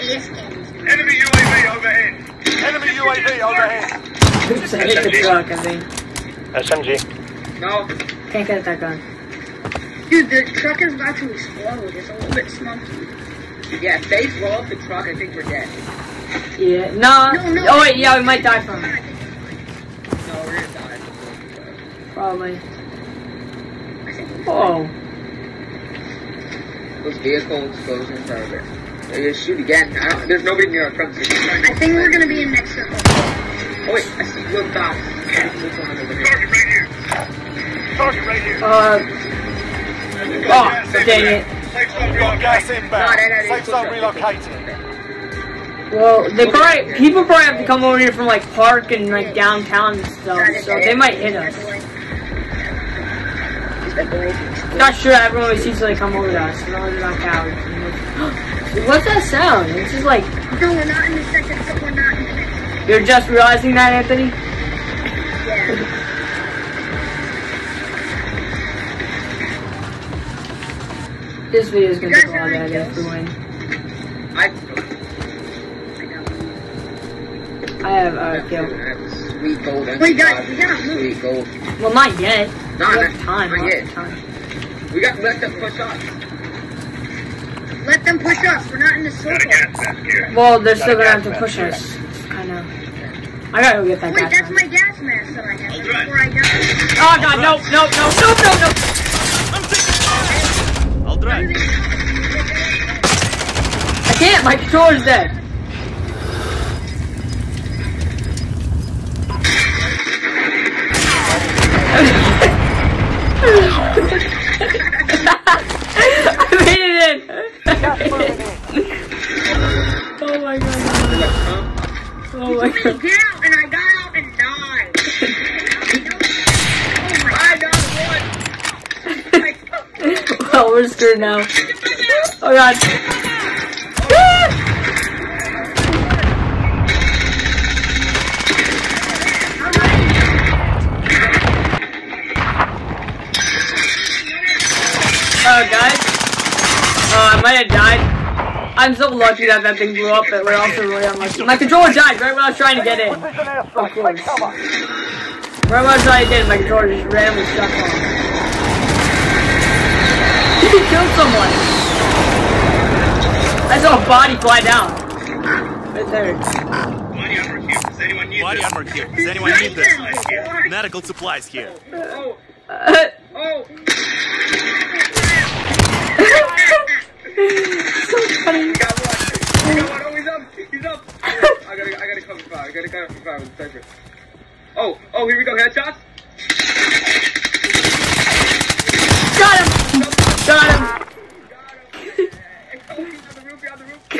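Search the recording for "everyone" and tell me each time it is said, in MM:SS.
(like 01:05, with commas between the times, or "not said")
00:55, 01:12.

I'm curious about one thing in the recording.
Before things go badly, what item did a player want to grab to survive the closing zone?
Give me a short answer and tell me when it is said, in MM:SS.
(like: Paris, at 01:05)
gas mask, at 01:34.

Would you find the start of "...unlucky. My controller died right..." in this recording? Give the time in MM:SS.
02:31.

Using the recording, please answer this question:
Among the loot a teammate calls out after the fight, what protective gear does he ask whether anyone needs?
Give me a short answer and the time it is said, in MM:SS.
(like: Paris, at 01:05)
body armor, at 02:48.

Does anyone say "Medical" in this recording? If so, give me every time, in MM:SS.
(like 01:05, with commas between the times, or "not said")
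02:50.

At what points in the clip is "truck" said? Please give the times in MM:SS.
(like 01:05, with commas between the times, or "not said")
00:05, 00:10, 00:14.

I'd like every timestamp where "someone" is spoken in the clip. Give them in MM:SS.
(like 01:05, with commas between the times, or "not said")
02:41.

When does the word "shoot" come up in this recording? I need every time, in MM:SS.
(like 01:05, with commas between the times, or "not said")
00:29.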